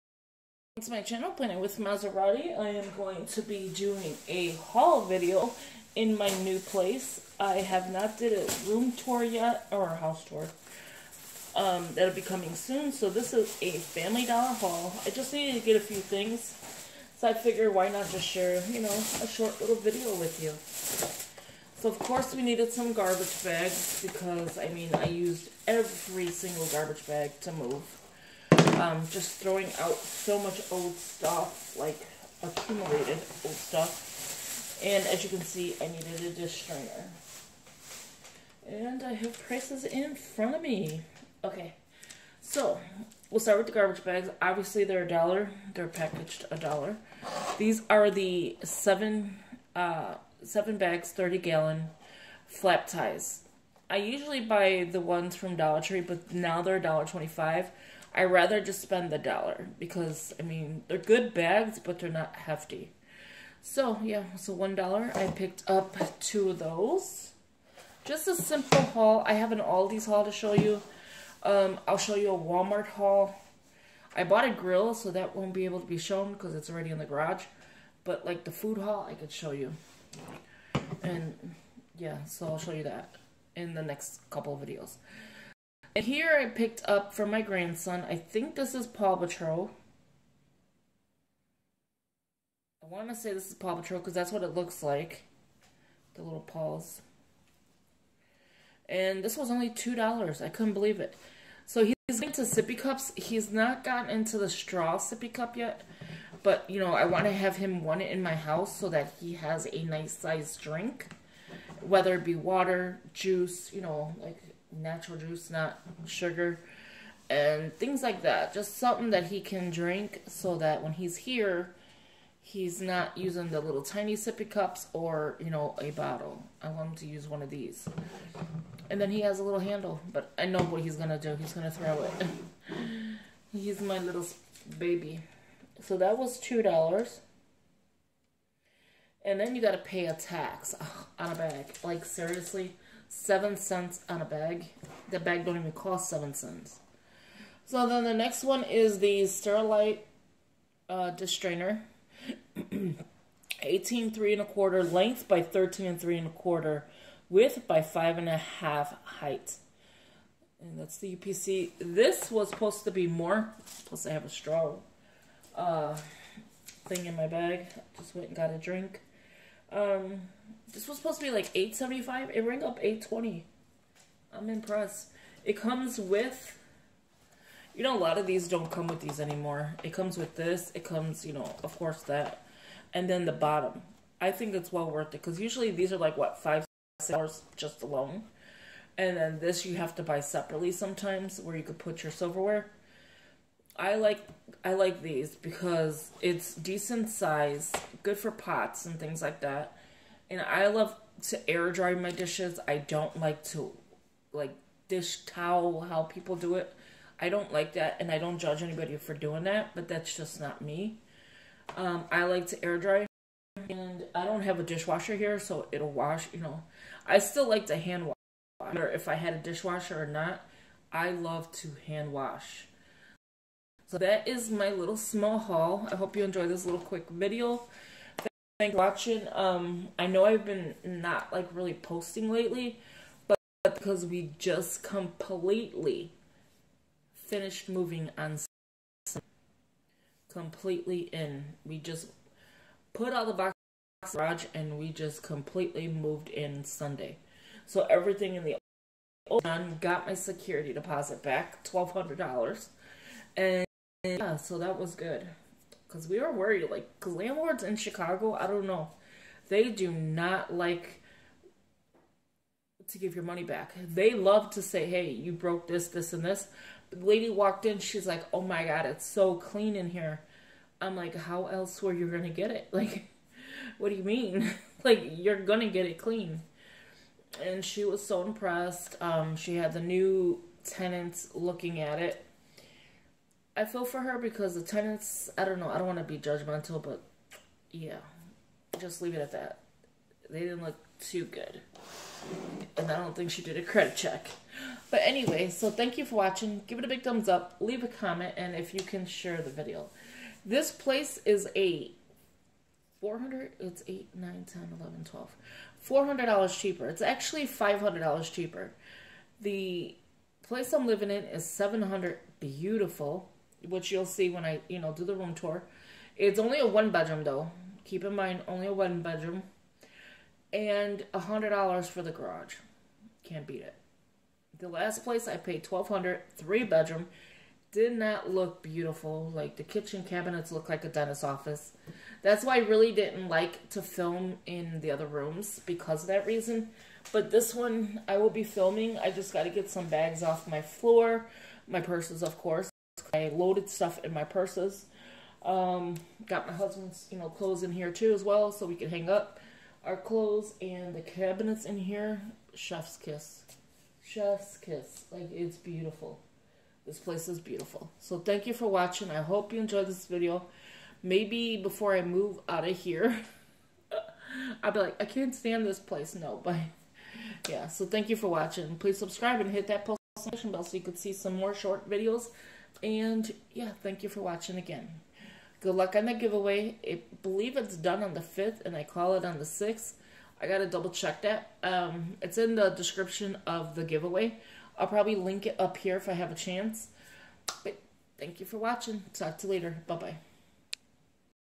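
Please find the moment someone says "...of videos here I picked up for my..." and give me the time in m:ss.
1:24.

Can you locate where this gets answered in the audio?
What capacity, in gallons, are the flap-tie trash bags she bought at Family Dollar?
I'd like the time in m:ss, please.
0:51.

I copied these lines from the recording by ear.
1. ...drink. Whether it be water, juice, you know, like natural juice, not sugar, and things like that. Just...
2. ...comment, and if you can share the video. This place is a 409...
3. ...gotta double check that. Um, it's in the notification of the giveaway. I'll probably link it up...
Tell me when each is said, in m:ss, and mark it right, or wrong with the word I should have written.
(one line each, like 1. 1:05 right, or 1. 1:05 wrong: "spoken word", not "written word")
1. 1:50 right
2. 4:57 wrong: "400", not "409"
3. 6:20 wrong: "description", not "notification".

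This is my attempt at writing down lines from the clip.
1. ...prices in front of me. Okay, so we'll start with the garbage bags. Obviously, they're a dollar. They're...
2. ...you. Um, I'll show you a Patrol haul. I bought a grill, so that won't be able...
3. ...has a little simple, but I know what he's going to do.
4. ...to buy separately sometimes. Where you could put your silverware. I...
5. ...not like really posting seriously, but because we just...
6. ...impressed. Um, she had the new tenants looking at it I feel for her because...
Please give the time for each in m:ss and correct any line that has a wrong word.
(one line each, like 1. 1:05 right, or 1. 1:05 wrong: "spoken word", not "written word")
1. 0:39 right
2. 1:10 wrong: "Walmart", not "Patrol"
3. 2:09 wrong: "handle", not "simple"
4. 3:09 right
5. 3:50 wrong: "lately", not "seriously"
6. 4:38 right.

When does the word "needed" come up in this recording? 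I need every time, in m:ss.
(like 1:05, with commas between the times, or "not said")
0:15, 0:22, 0:35.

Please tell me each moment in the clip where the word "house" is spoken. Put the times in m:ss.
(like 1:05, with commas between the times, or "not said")
0:09, 1:48.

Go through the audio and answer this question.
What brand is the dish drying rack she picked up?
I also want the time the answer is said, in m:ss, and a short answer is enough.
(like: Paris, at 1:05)
Sterilite, at 2:29.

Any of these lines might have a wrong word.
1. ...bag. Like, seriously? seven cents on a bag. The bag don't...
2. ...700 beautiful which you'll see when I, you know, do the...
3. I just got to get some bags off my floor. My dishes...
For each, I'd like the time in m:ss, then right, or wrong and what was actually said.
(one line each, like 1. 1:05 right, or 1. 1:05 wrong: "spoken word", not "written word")
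1. 2:21 right
2. 5:11 right
3. 5:38 wrong: "purses", not "dishes".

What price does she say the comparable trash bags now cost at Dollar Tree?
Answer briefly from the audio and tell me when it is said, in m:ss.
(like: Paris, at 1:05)
$1.25, at 0:56.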